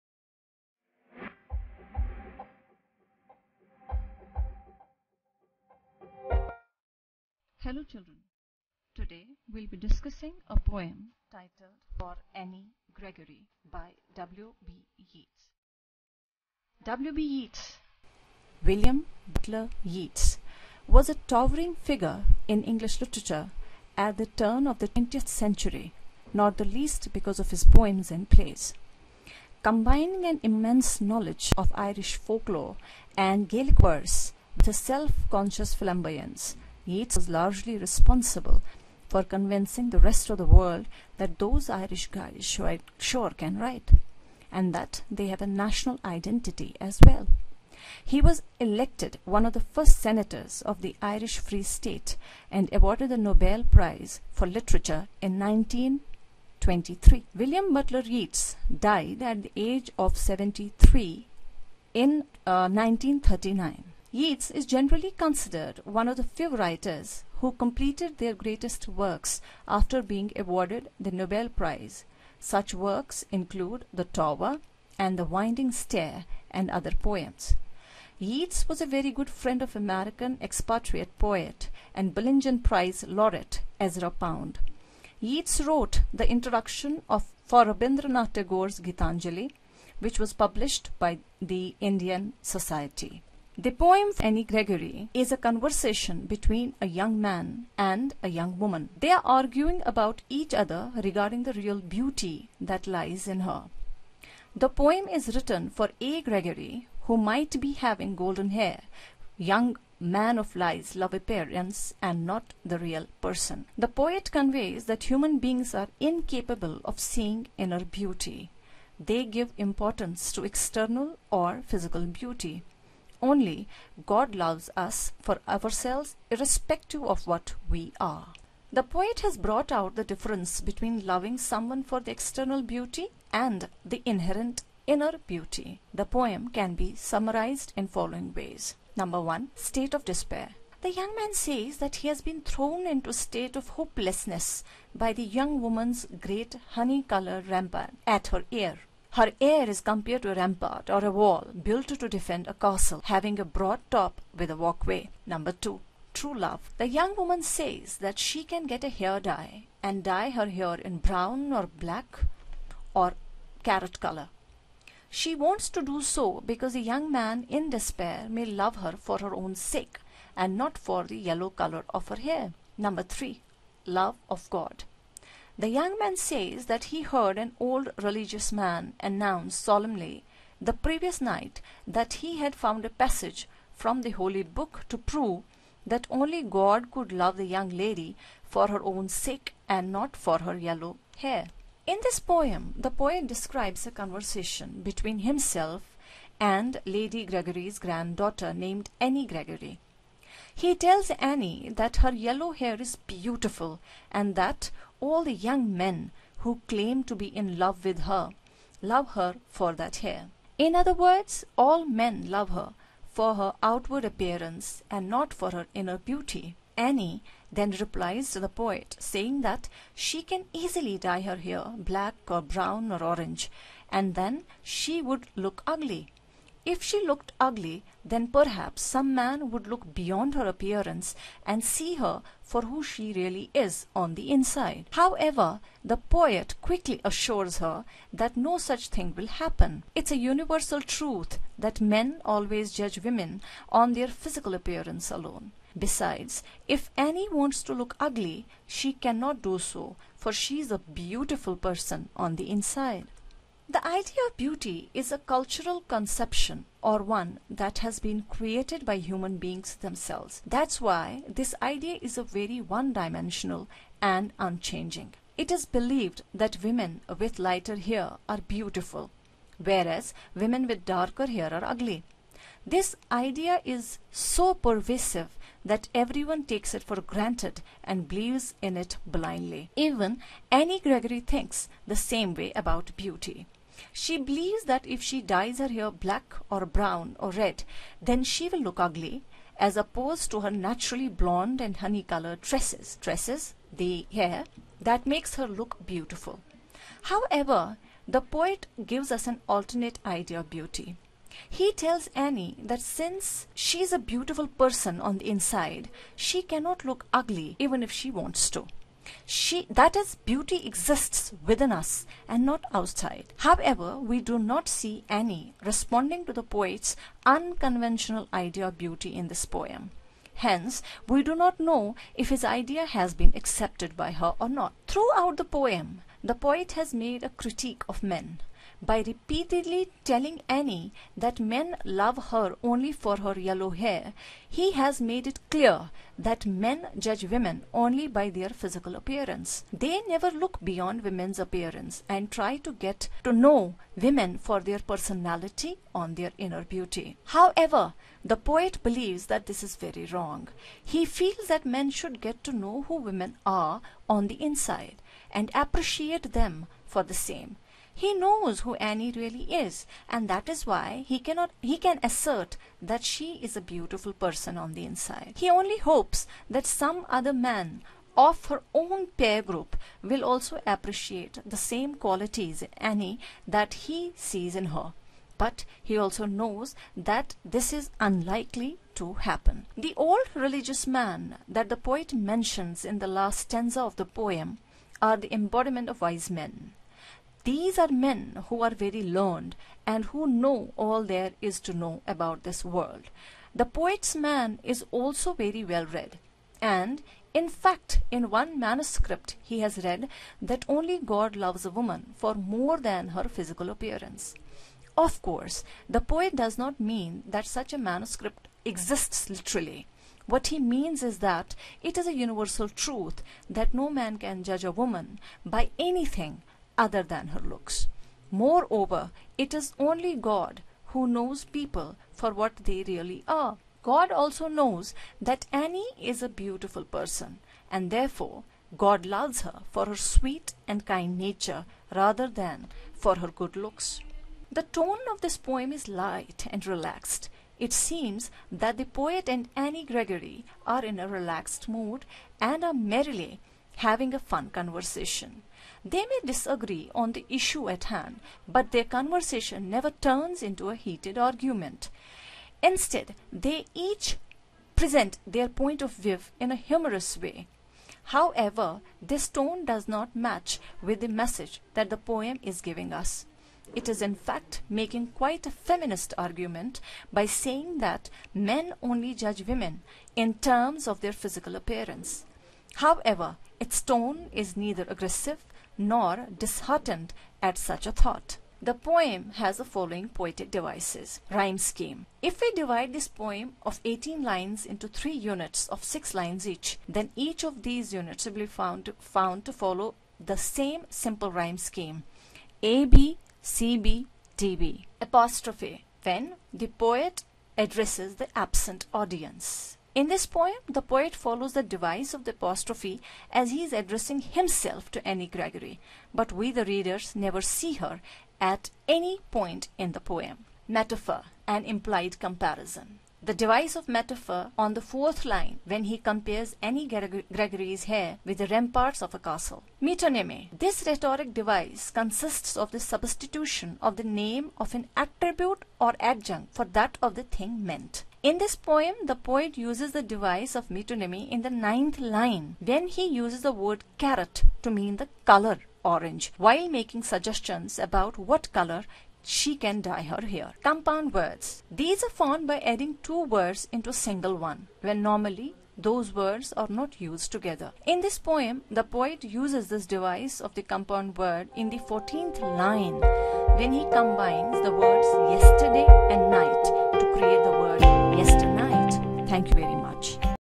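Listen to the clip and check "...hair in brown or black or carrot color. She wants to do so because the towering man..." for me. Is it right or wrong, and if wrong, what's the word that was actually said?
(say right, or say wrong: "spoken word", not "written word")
wrong: "young", not "towering".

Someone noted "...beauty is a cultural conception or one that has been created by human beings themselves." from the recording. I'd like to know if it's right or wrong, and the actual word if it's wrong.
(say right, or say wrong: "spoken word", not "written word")
right.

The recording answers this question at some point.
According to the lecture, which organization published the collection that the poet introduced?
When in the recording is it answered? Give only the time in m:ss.
1:31.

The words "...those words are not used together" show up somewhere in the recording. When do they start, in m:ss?
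9:05.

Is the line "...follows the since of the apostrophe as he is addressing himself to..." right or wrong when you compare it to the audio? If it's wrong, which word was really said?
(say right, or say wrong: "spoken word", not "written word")
wrong: "device", not "since".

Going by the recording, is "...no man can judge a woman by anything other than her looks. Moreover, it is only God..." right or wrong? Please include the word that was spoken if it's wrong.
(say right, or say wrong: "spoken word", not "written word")
right.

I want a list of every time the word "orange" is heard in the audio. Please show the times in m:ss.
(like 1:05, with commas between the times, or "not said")
3:43, 8:55.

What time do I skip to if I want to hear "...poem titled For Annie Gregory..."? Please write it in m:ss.
0:10.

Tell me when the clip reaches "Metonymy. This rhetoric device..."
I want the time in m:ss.
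8:39.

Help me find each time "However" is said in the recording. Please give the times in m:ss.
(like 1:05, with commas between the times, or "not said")
3:54, 4:57, 5:13, 5:47, 7:38, 7:52.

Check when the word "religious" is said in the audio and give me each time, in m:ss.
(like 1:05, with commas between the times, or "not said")
2:57, 6:20.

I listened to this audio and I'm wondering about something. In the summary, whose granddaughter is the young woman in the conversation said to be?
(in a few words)
Lady Gregory.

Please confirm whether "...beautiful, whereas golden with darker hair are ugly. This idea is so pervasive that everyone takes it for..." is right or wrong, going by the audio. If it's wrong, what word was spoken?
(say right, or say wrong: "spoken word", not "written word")
wrong: "women", not "golden".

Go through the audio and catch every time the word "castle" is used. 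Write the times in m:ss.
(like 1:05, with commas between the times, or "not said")
2:32, 8:39.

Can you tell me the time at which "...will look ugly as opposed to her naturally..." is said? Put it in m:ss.
4:48.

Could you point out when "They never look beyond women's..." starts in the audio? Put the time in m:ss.
5:39.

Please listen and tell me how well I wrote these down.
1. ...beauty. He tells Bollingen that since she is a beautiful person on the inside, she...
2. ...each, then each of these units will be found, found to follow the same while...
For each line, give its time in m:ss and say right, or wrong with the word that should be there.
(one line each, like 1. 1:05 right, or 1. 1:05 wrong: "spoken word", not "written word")
1. 5:00 wrong: "Annie", not "Bollingen"
2. 8:06 wrong: "simple", not "while".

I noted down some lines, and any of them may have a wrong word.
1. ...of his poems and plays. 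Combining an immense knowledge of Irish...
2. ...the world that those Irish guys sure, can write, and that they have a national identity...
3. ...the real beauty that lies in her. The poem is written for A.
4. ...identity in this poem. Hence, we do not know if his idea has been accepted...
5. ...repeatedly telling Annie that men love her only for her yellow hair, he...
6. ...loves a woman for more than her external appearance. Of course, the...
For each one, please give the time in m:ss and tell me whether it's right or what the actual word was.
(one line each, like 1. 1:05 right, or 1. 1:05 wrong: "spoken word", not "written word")
1. 0:27 right
2. 0:40 right
3. 1:41 right
4. 5:18 wrong: "beauty", not "identity"
5. 5:29 right
6. 6:41 wrong: "physical", not "external".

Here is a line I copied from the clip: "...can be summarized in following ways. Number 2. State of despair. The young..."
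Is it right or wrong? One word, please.
wrong.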